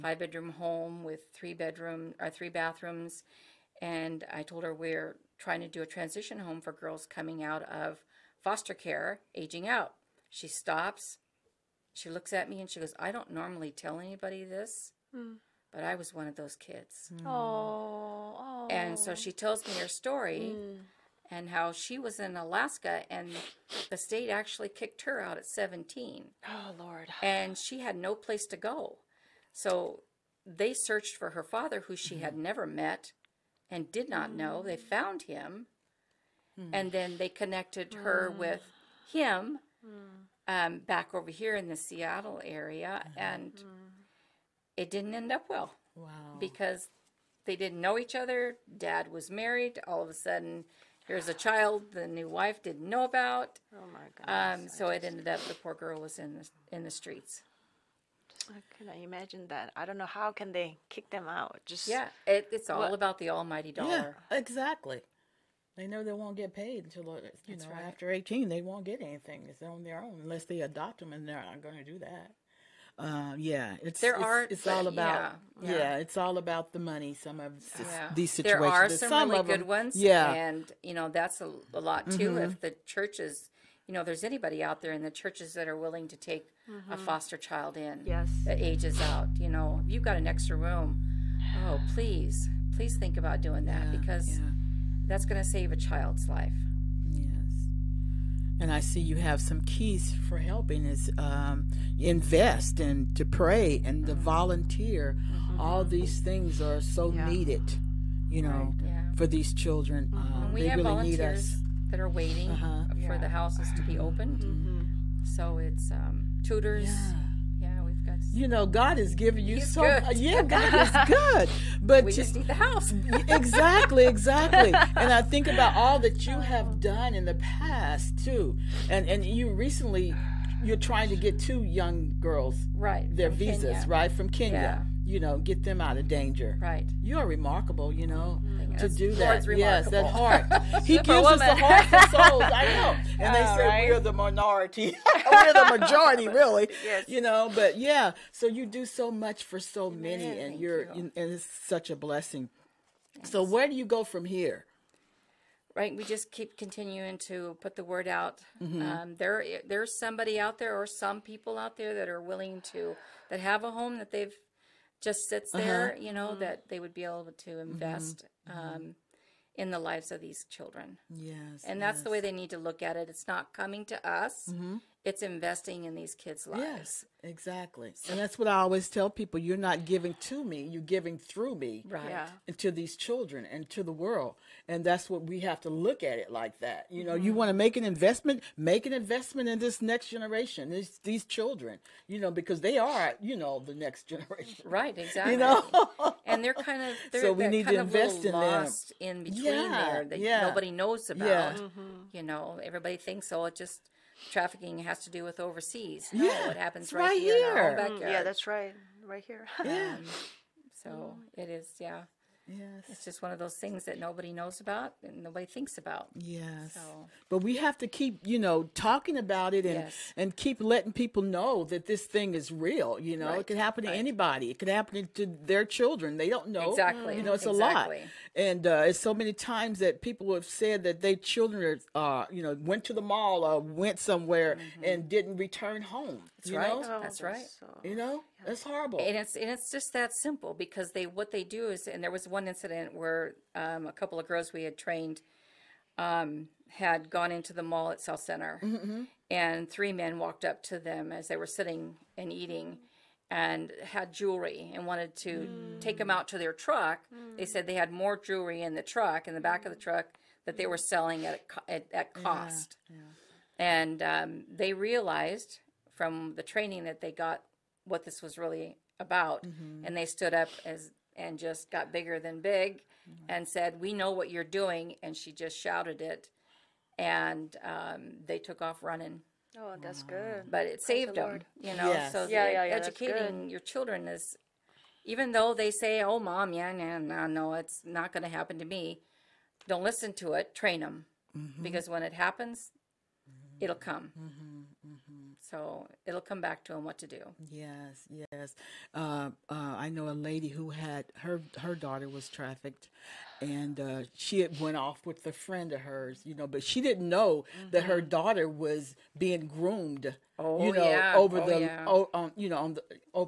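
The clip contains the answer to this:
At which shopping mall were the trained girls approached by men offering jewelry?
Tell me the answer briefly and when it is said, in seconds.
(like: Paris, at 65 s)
South Center, at 247 s.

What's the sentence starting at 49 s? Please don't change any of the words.
All of a sudden, here's a child the new wife didn't know about.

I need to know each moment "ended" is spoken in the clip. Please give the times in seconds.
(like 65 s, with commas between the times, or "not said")
55 s.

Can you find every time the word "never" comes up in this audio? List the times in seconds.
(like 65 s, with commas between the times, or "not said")
32 s.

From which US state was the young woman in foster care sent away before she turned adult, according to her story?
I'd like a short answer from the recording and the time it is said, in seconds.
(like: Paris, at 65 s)
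Alaska, at 22 s.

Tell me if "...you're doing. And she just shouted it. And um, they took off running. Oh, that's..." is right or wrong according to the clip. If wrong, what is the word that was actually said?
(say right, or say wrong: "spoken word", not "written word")
right.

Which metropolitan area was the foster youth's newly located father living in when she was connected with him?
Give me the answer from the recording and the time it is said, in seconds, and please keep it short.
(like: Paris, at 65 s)
Seattle, at 41 s.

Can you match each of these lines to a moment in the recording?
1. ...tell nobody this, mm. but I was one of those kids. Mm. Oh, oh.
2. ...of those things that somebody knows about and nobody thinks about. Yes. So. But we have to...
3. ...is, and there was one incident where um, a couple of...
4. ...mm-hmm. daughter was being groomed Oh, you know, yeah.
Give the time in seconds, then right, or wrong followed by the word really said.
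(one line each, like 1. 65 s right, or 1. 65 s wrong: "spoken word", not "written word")
1. 13 s wrong: "anybody", not "nobody"
2. 213 s wrong: "nobody", not "somebody"
3. 241 s right
4. 307 s right.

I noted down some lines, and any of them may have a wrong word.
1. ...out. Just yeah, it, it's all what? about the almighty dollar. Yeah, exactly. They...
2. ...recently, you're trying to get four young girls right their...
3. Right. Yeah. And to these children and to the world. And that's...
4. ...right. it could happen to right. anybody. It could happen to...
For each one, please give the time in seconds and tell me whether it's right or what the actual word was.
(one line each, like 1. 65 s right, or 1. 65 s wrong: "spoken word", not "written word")
1. 61 s right
2. 129 s wrong: "two", not "four"
3. 181 s right
4. 223 s right.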